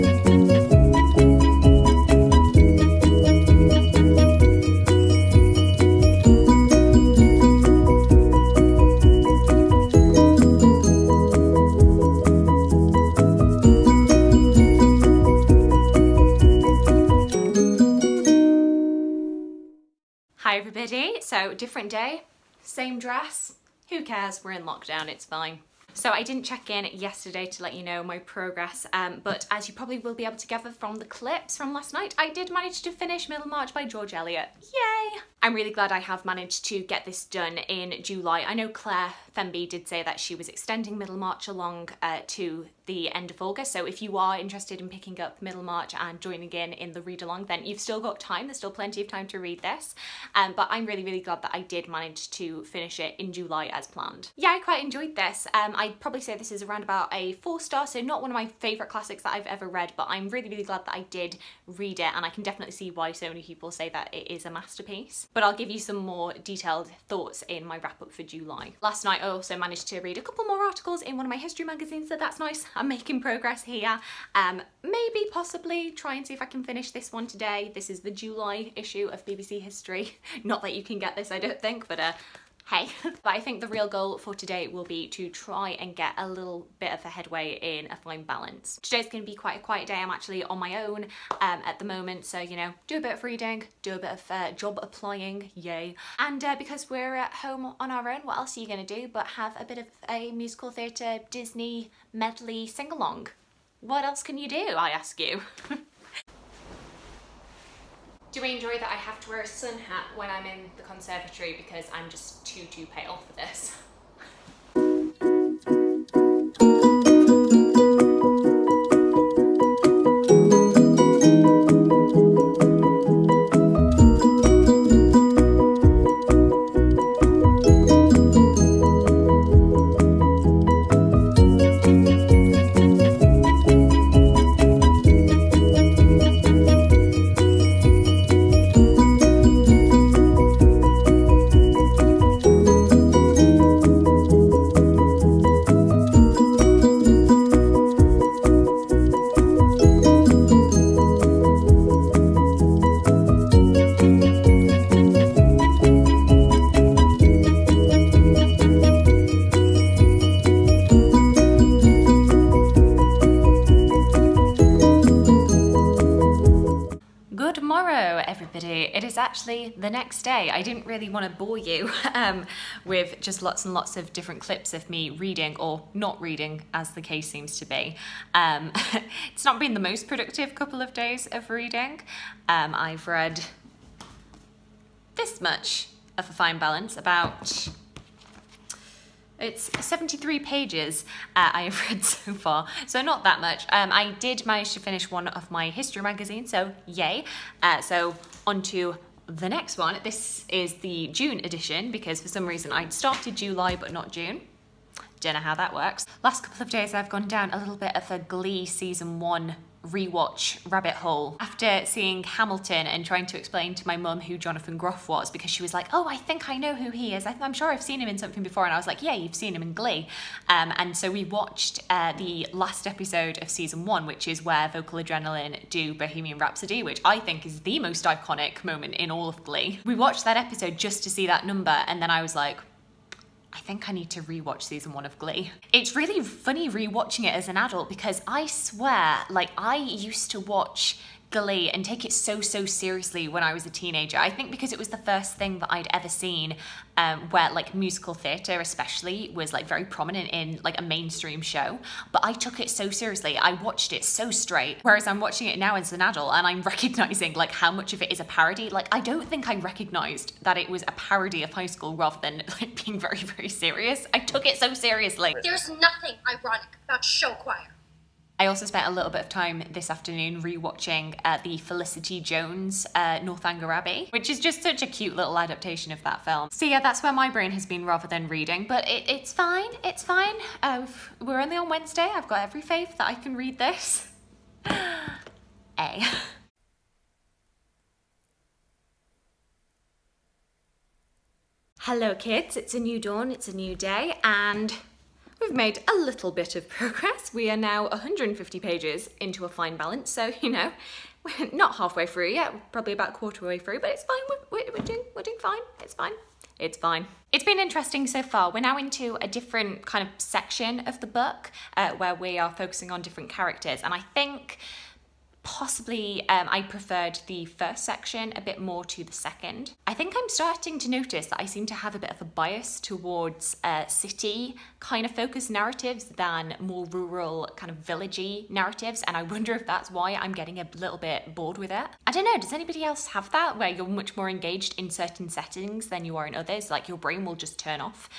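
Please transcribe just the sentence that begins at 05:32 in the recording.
I don't know, does anybody else have that where you're much more engaged in certain settings than you are in others?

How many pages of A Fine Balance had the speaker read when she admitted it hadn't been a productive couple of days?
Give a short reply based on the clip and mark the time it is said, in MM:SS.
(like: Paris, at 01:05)
73, at 03:09.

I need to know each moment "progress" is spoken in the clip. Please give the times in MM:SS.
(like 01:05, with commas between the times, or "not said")
00:28, 01:13, 04:56.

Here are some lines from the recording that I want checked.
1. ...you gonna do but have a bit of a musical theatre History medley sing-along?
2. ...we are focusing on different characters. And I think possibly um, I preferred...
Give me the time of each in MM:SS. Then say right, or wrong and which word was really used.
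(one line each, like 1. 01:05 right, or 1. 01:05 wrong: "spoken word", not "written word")
1. 01:38 wrong: "Disney", not "History"
2. 05:12 right.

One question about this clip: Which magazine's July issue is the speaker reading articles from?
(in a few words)
BBC History.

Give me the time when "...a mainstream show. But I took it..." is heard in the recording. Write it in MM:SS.
04:10.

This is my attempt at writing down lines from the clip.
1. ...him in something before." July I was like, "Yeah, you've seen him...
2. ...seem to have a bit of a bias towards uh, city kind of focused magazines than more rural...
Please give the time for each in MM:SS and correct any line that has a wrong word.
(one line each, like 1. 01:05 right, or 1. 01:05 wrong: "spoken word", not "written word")
1. 03:38 wrong: "And", not "July"
2. 05:21 wrong: "narratives", not "magazines".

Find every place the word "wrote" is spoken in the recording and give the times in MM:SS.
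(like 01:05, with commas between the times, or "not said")
not said.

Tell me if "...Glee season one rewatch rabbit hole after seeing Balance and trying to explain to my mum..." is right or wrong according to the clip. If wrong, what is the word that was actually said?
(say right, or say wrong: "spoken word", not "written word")
wrong: "Hamilton", not "Balance".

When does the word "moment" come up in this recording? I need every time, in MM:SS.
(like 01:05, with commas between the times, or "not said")
01:31, 03:48.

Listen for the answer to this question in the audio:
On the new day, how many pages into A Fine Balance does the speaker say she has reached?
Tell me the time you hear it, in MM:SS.
04:57.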